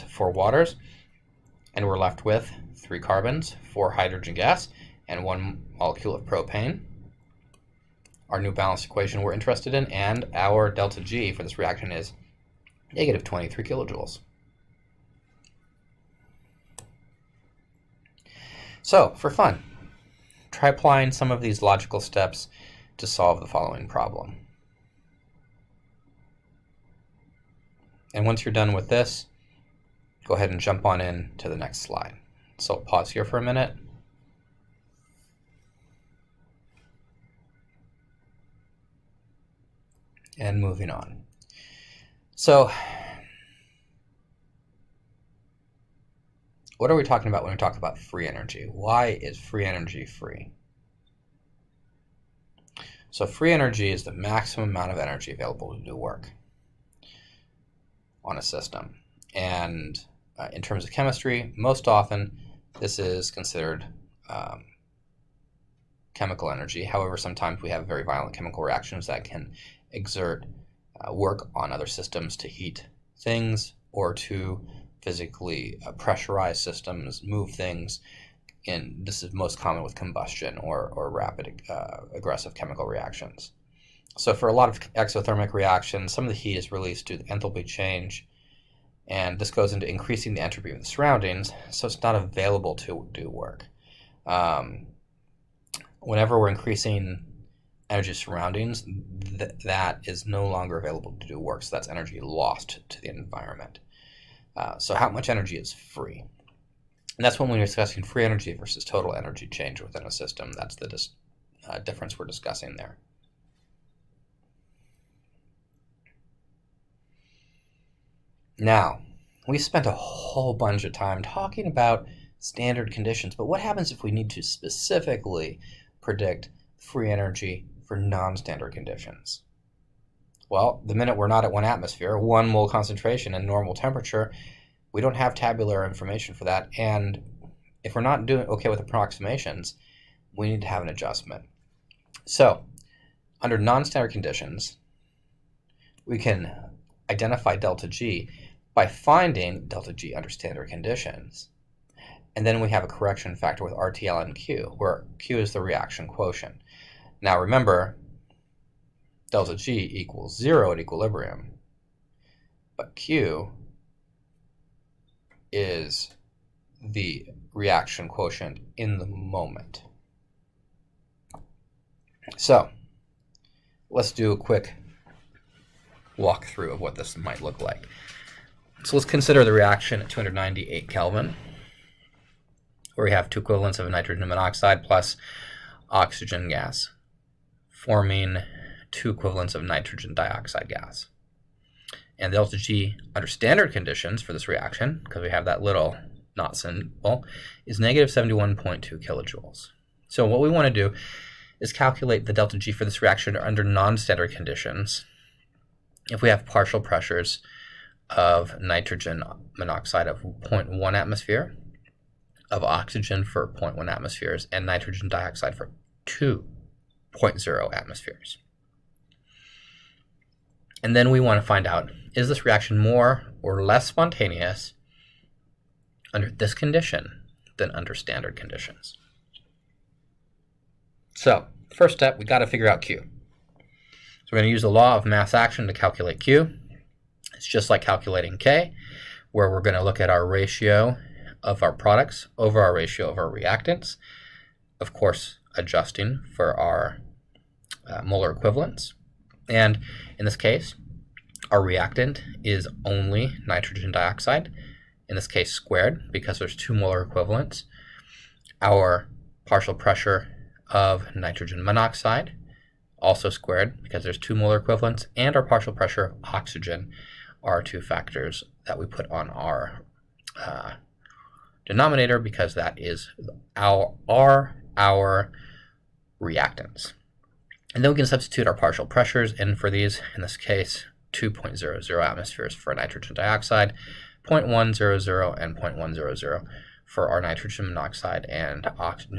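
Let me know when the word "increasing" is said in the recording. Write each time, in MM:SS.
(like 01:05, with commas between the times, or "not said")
01:29, 01:36.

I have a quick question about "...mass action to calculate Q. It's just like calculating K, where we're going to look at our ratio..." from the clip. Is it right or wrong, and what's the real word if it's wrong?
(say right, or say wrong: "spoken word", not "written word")
right.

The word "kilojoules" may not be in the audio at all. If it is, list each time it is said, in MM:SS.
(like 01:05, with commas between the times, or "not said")
00:13, 03:19.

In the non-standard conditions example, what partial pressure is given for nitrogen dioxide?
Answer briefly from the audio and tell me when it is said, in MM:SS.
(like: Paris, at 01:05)
2.0 atm, at 03:36.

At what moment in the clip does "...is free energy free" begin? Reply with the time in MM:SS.
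00:49.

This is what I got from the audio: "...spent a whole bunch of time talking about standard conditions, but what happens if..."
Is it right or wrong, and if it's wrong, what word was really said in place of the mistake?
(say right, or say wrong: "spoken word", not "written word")
right.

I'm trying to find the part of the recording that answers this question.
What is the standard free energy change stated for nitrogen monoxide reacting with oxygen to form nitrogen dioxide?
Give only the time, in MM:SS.
03:17.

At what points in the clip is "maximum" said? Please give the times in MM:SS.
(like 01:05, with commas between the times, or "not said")
00:54.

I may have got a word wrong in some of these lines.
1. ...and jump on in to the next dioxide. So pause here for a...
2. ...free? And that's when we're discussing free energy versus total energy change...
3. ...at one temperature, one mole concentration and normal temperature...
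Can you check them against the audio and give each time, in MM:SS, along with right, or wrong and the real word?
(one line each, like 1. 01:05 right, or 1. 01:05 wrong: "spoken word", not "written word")
1. 00:30 wrong: "slide", not "dioxide"
2. 01:45 right
3. 02:11 wrong: "atmosphere", not "temperature".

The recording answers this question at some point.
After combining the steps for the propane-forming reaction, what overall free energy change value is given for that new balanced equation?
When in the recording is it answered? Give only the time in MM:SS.
00:12.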